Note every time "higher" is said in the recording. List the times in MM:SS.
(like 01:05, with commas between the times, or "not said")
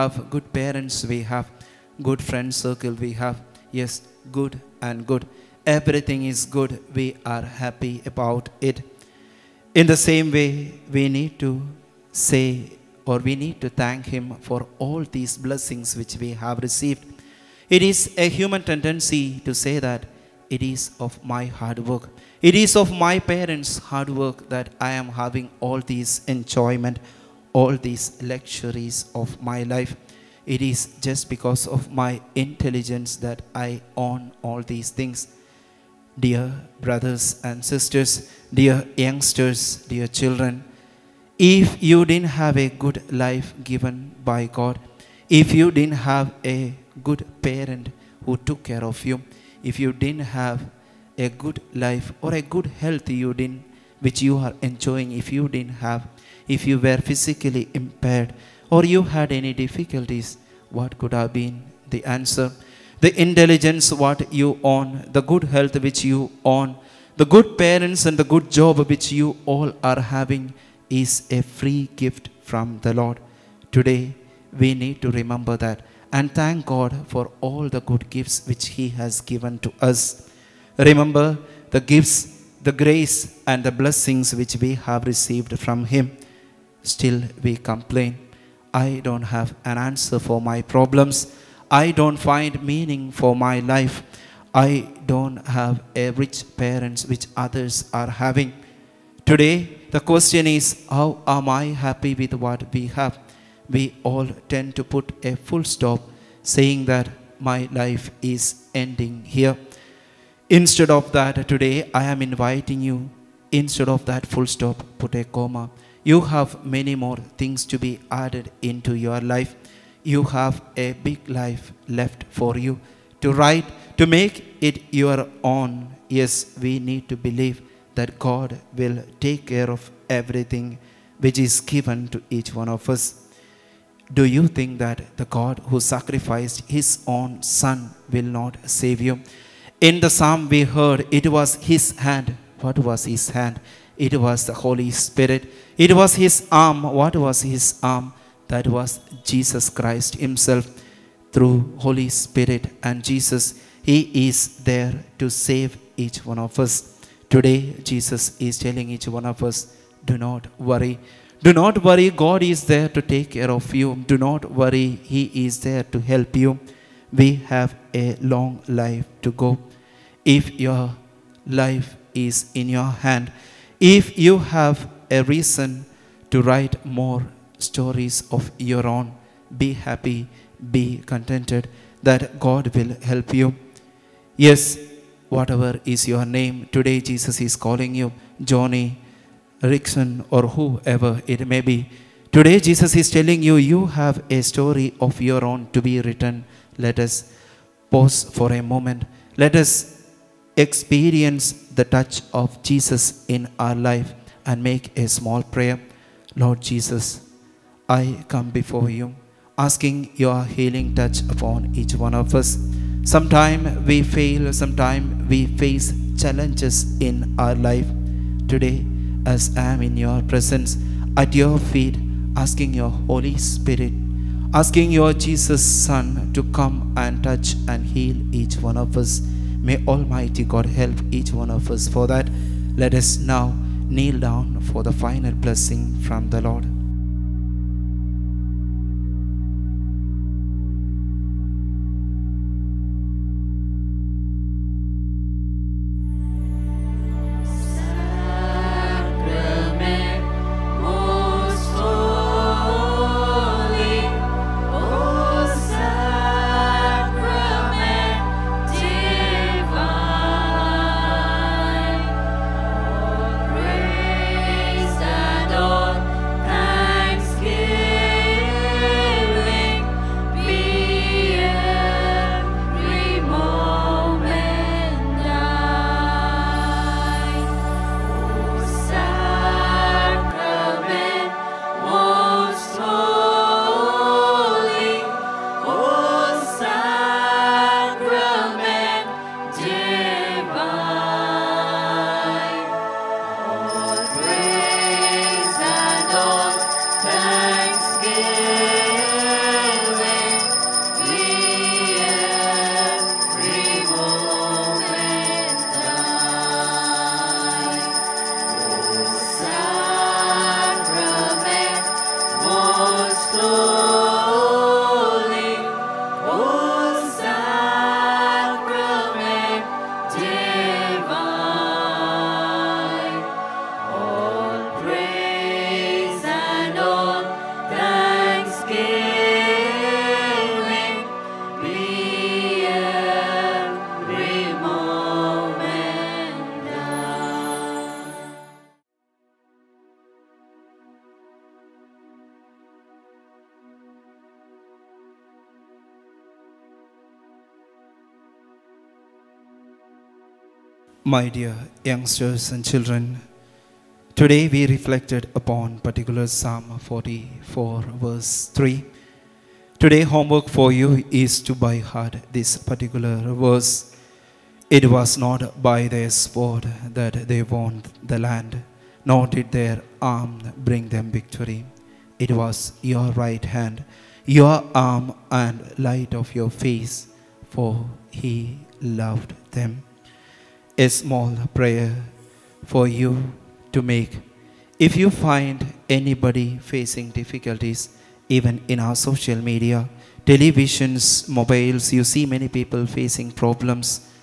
not said.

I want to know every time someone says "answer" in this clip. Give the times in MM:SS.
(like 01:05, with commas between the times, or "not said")
01:02, 01:29.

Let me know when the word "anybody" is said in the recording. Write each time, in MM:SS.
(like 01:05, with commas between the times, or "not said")
06:25.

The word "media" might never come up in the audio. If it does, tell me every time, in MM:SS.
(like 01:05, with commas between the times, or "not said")
06:29.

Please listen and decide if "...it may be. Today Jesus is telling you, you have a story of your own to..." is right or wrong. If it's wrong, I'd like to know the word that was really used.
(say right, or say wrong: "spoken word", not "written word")
right.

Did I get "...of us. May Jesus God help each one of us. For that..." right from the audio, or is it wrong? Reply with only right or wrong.
wrong.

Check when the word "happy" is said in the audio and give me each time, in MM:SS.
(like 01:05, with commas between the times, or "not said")
00:07, 01:41, 02:59.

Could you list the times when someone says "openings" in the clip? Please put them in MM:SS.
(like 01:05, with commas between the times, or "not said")
not said.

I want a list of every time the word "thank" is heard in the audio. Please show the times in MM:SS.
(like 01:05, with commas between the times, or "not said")
00:13, 01:16.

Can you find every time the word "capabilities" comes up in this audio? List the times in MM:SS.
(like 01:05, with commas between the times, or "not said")
not said.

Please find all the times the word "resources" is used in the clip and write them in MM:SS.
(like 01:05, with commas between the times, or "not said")
not said.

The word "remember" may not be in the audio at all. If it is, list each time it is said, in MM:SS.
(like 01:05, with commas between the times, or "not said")
01:15, 01:20.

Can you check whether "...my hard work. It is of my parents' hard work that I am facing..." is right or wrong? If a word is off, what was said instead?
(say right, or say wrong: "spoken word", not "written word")
wrong: "having", not "facing".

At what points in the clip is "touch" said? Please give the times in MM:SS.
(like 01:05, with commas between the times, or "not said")
03:21, 03:30, 03:47.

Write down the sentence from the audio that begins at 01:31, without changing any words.
I don't find meaning for my life.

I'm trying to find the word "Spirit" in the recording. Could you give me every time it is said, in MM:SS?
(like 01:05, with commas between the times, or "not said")
02:24, 02:32, 03:43.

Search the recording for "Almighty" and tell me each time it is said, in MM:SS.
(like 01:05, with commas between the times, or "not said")
03:49.